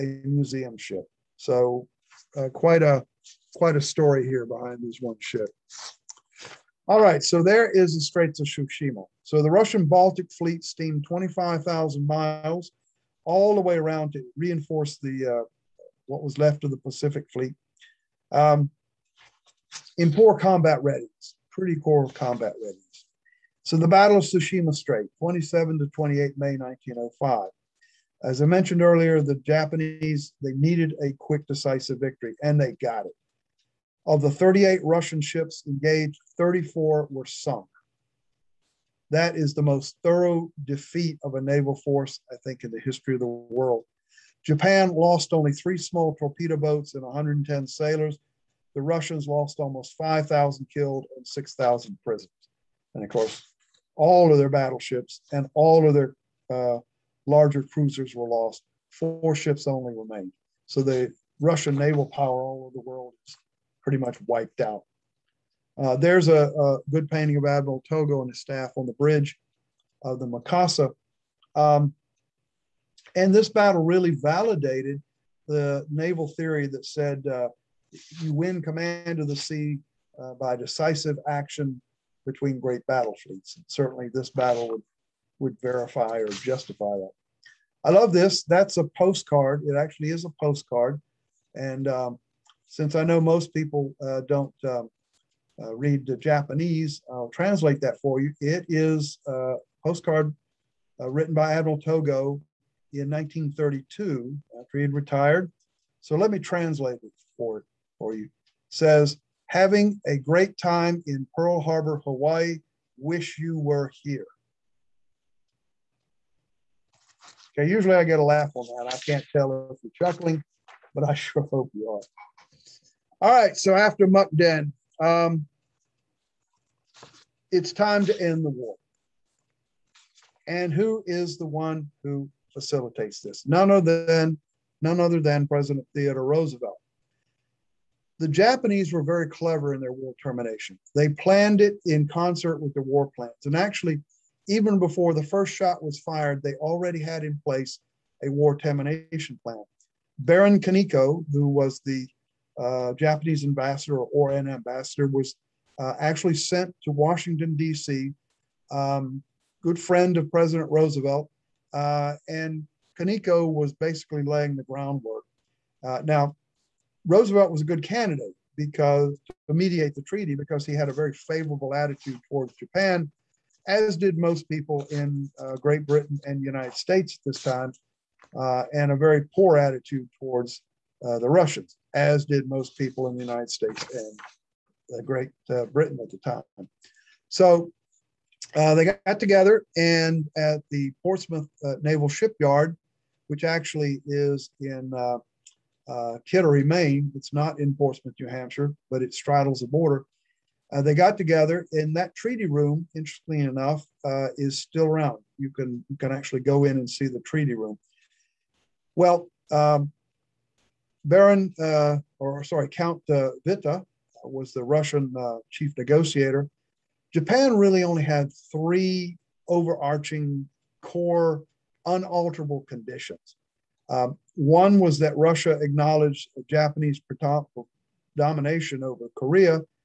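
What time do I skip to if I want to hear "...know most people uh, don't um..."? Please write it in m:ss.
1:33.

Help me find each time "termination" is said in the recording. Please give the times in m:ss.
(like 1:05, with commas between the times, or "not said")
2:20, 2:28.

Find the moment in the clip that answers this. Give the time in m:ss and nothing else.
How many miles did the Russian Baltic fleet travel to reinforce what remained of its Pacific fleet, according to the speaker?
0:11.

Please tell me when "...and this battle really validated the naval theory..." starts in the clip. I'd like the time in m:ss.
1:13.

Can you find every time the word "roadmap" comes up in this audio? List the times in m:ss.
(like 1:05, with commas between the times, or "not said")
not said.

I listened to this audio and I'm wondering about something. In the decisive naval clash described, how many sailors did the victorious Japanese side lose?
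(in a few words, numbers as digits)
110.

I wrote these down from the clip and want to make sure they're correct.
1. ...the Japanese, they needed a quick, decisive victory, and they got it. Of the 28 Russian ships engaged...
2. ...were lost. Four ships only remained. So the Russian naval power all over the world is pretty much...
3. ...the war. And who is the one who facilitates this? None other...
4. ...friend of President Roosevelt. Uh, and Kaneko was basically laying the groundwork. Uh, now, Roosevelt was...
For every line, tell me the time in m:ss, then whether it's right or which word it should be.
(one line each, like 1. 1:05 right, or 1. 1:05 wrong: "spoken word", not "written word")
1. 0:29 wrong: "38", not "28"
2. 0:58 right
3. 2:08 right
4. 2:39 right.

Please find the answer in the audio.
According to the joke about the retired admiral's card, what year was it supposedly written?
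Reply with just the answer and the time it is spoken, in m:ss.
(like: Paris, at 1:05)
1932, at 1:43.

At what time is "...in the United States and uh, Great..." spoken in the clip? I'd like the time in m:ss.
3:03.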